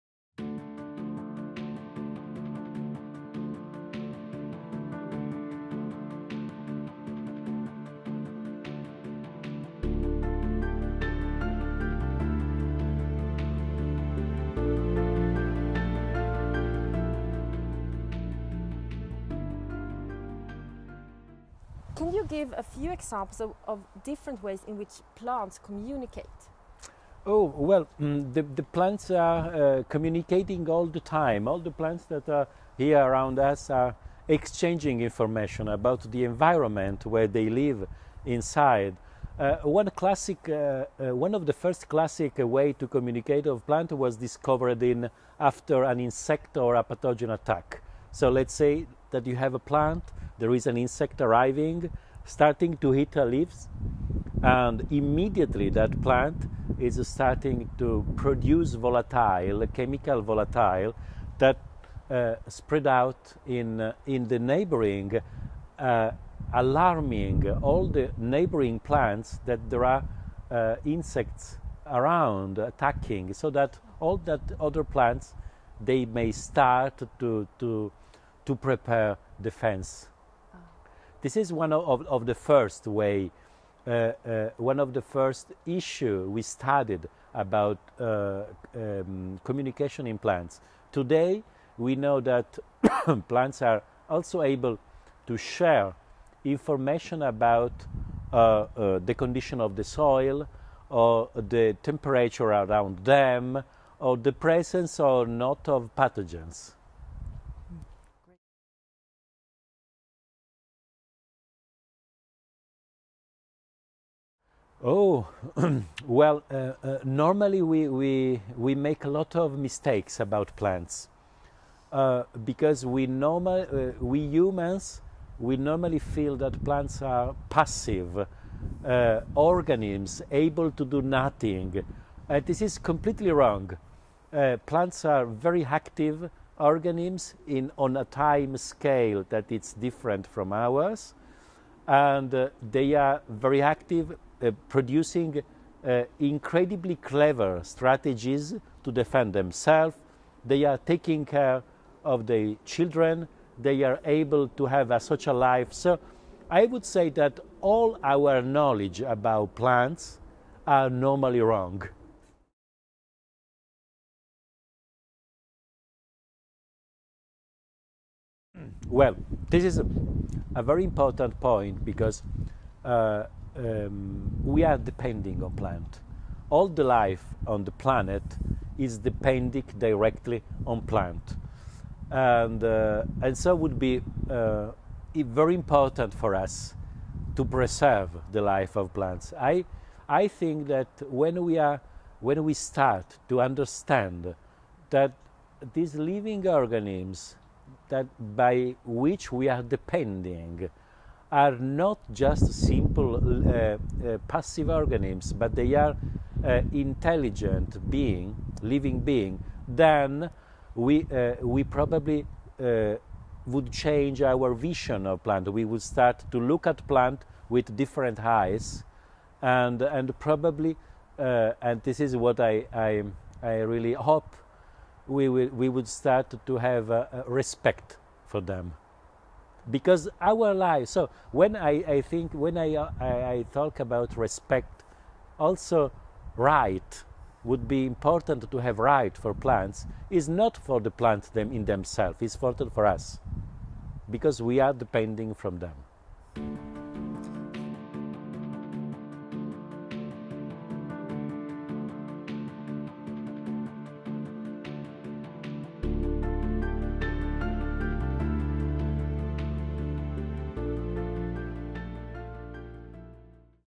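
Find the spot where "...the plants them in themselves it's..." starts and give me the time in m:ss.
4:00.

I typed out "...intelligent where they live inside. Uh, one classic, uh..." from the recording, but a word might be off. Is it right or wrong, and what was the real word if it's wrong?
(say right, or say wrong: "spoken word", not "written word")
wrong: "environment", not "intelligent".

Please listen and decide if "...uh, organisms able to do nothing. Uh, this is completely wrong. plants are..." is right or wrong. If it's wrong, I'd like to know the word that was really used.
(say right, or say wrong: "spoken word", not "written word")
right.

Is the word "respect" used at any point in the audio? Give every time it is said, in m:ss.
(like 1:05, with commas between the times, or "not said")
3:47, 3:54.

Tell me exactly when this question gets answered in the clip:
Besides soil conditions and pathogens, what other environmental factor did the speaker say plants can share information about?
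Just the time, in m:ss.
1:41.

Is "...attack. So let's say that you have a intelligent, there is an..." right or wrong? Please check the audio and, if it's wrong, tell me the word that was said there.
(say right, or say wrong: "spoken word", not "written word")
wrong: "plant", not "intelligent".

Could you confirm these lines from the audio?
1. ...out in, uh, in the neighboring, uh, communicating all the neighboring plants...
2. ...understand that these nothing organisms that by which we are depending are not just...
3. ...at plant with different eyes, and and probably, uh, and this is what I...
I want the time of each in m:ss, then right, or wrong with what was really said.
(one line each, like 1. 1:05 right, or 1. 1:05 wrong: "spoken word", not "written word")
1. 1:02 wrong: "alarming", not "communicating"
2. 3:13 wrong: "living", not "nothing"
3. 3:36 right.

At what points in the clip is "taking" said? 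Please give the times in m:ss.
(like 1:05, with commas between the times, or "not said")
2:30.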